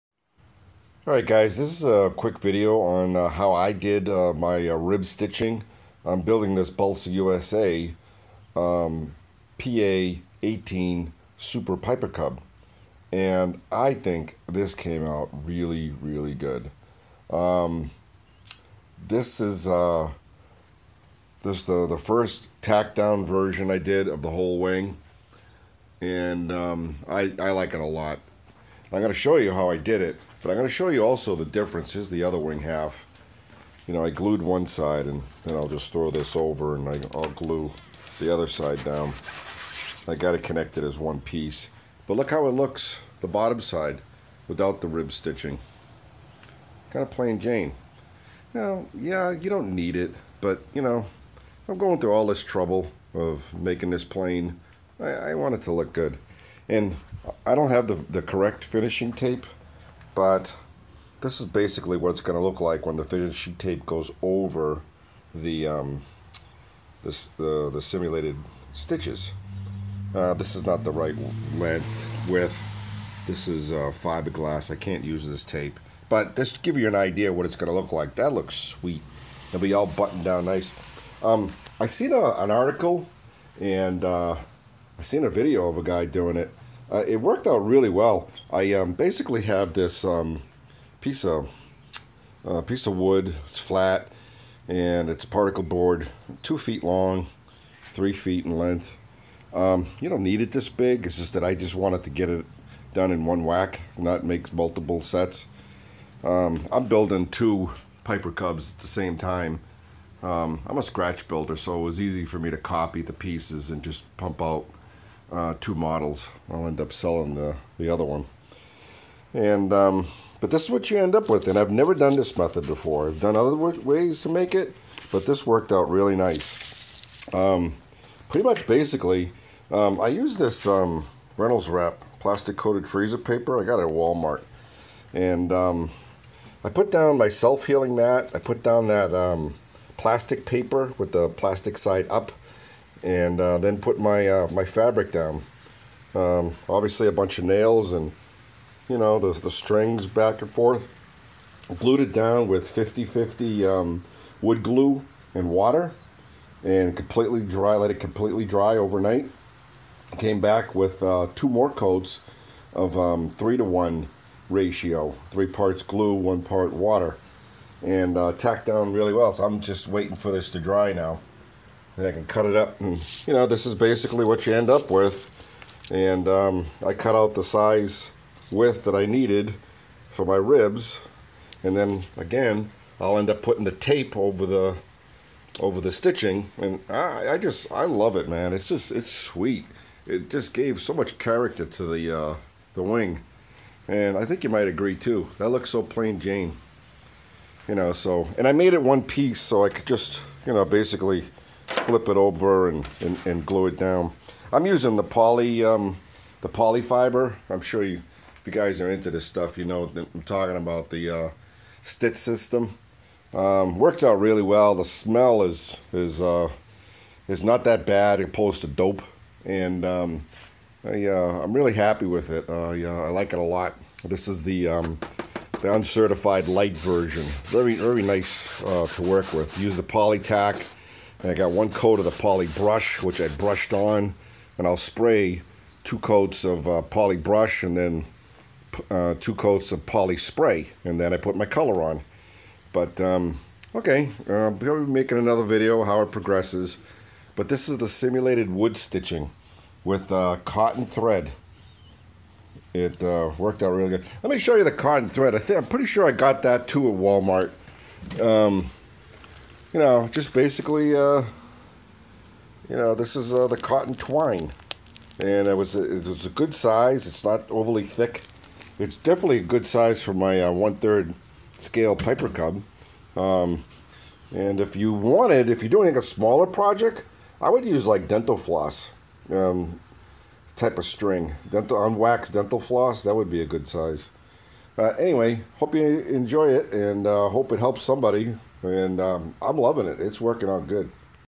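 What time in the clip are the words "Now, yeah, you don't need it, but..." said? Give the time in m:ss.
0:48.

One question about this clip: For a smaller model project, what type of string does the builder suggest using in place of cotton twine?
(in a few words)
Unwaxed dental floss.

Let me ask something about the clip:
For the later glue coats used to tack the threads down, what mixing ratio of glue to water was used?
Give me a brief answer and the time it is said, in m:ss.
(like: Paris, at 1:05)
3 to 1, at 2:43.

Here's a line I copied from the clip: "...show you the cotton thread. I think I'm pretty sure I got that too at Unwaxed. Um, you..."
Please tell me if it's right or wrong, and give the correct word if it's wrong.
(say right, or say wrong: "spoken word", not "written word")
wrong: "Walmart", not "Unwaxed".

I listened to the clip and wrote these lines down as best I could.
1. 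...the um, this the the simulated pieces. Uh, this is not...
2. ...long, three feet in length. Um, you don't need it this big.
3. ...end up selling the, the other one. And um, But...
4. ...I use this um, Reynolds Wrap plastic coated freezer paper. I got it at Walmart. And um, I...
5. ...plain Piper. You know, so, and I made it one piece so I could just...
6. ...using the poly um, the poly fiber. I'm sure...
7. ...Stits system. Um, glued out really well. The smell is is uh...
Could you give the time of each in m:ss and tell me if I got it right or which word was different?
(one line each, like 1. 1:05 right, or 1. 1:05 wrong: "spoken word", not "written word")
1. 1:05 wrong: "stitches", not "pieces"
2. 1:36 right
3. 1:56 right
4. 2:10 right
5. 3:15 wrong: "Jane", not "Piper"
6. 3:24 right
7. 3:31 wrong: "worked", not "glued".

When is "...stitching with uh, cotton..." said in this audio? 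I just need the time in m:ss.
4:08.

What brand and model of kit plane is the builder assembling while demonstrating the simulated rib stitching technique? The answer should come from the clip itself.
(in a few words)
Balsa USA PA-18 Super Piper Cub.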